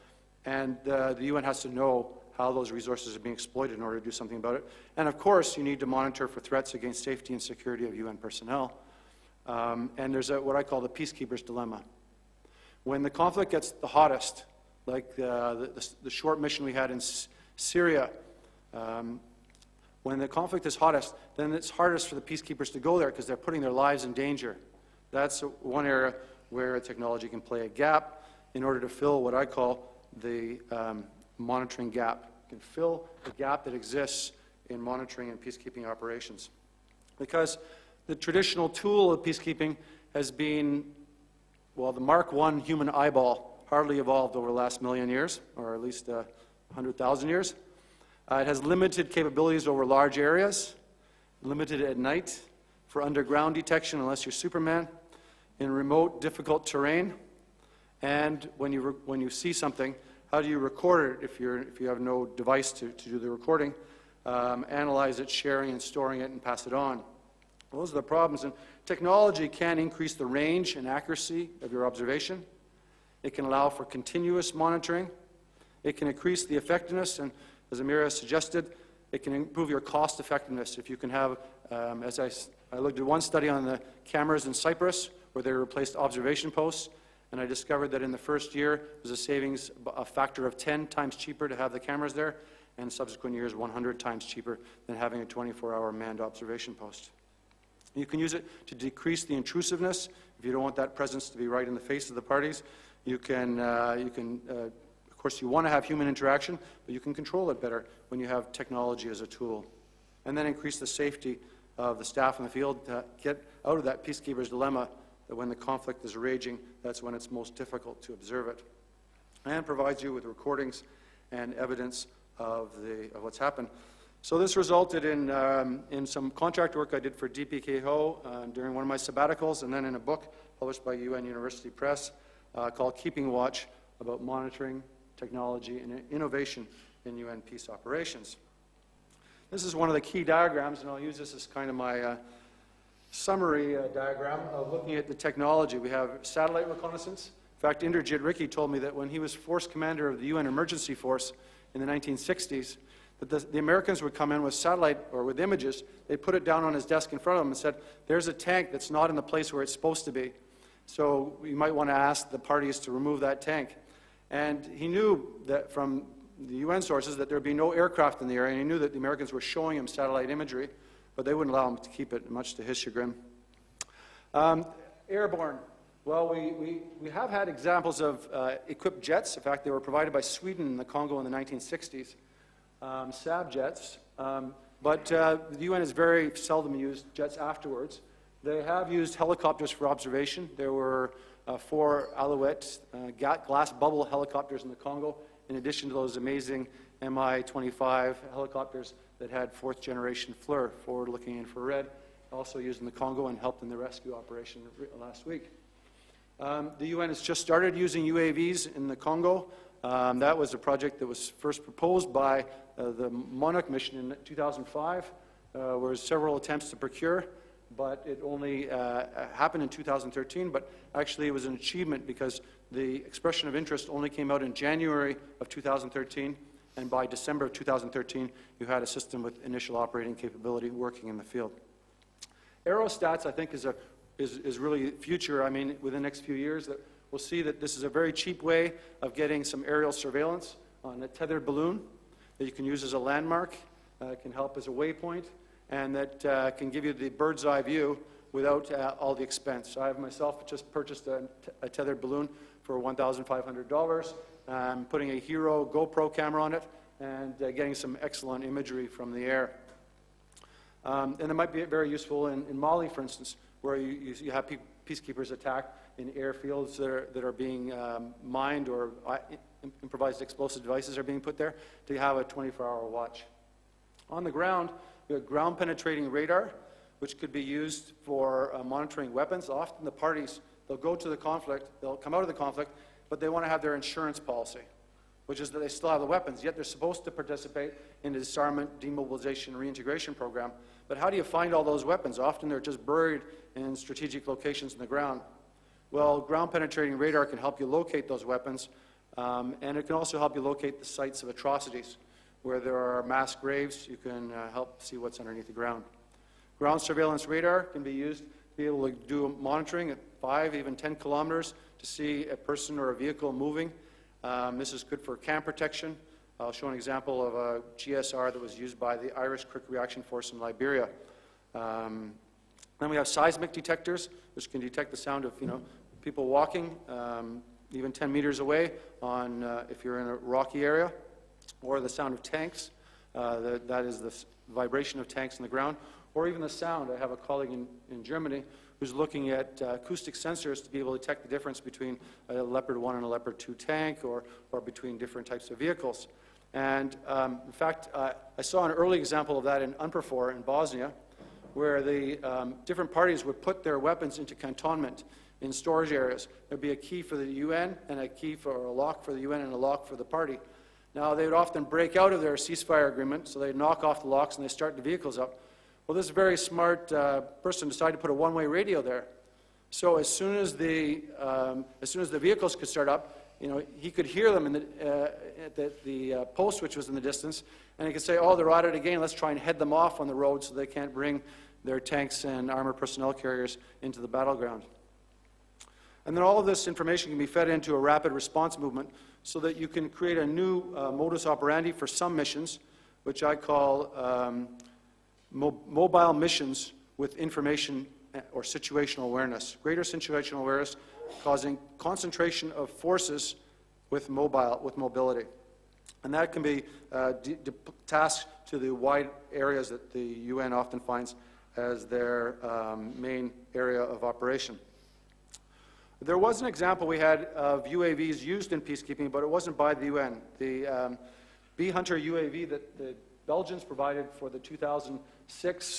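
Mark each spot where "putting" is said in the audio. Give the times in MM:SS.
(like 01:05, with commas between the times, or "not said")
00:23, 04:14.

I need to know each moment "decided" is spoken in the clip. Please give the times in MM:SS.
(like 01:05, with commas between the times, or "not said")
06:07.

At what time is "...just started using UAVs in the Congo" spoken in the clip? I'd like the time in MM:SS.
03:27.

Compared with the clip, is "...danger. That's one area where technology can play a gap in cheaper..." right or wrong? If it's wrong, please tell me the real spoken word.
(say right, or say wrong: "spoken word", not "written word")
wrong: "order", not "cheaper".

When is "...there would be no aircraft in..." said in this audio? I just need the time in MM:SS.
02:47.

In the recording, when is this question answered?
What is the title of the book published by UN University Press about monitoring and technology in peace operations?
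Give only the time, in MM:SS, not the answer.
02:12.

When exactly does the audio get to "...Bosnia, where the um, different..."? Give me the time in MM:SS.
05:50.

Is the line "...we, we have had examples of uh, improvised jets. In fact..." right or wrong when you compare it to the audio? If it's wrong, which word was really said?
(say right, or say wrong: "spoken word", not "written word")
wrong: "equipped", not "improvised".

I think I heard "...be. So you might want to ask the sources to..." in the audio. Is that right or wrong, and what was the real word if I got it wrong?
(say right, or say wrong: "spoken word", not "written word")
wrong: "parties", not "sources".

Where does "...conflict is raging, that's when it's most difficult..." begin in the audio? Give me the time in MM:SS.
01:55.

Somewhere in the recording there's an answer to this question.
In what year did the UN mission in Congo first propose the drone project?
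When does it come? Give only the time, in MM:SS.
03:34.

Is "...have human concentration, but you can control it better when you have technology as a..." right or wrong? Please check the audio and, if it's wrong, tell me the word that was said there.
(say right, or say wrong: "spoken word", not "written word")
wrong: "interaction", not "concentration".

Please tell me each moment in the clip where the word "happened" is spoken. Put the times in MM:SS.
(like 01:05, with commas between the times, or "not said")
02:03, 03:39.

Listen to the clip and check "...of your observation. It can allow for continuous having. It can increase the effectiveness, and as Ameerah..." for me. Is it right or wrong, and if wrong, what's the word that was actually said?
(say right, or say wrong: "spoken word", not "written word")
wrong: "monitoring", not "having".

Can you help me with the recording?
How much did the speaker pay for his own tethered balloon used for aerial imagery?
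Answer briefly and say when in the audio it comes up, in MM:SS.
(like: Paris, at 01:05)
$1,500, at 04:12.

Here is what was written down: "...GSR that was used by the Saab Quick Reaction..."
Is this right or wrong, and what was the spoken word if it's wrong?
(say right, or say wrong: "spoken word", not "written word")
wrong: "Irish", not "Saab".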